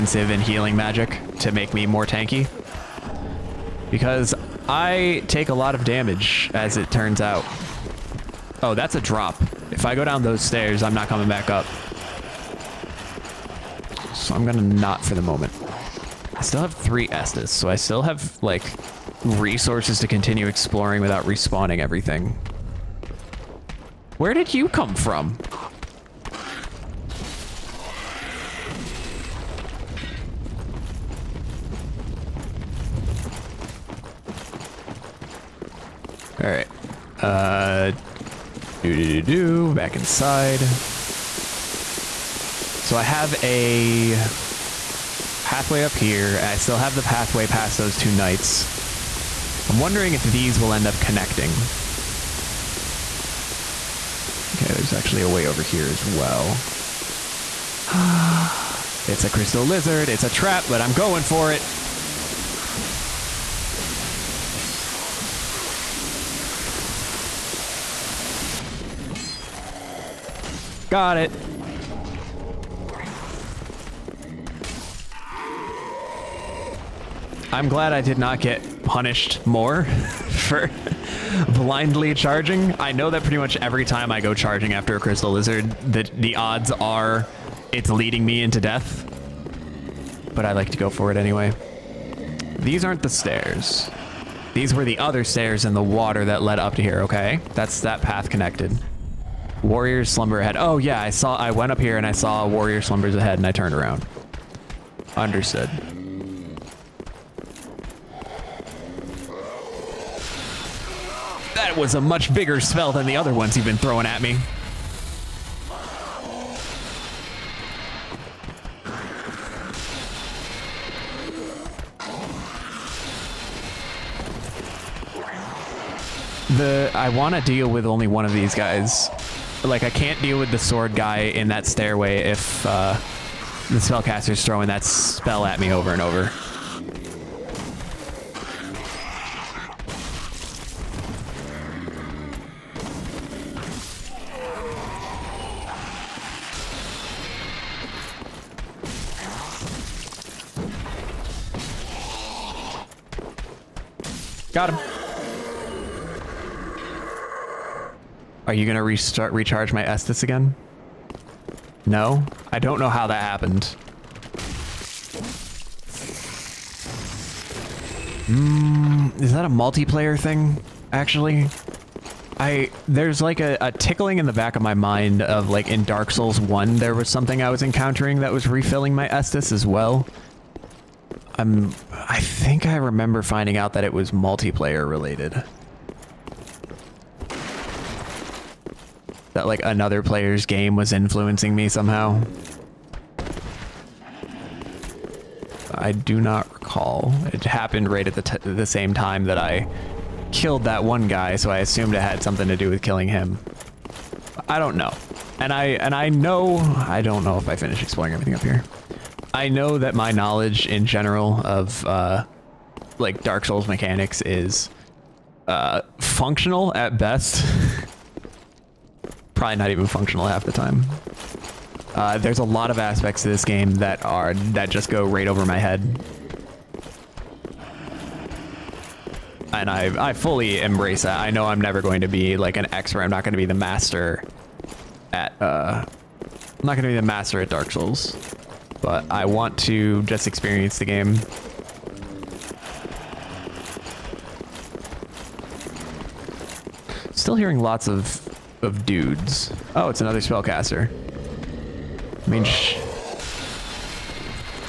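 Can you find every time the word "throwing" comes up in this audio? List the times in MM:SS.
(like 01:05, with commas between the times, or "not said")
01:53, 02:14.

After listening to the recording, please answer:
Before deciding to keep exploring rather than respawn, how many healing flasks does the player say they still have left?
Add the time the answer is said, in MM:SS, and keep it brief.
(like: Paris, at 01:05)
3, at 00:16.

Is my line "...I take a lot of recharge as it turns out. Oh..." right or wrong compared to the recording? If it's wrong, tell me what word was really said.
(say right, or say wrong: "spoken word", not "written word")
wrong: "damage", not "recharge".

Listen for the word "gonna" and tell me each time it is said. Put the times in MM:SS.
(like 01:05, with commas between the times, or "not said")
00:14, 02:38.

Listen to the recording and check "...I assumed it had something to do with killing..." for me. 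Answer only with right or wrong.
right.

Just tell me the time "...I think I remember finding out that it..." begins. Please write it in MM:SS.
03:01.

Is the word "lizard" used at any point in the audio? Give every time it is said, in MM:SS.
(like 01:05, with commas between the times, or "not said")
00:59, 01:25.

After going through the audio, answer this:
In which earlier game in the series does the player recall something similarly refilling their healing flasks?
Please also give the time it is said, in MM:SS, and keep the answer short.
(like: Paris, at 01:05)
Dark Souls 1, at 02:55.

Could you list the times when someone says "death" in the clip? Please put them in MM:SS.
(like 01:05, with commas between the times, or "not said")
01:28.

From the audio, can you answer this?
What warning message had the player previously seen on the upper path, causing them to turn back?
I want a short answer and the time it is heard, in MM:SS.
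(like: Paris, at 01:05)
Warrior's slumber ahead, at 01:39.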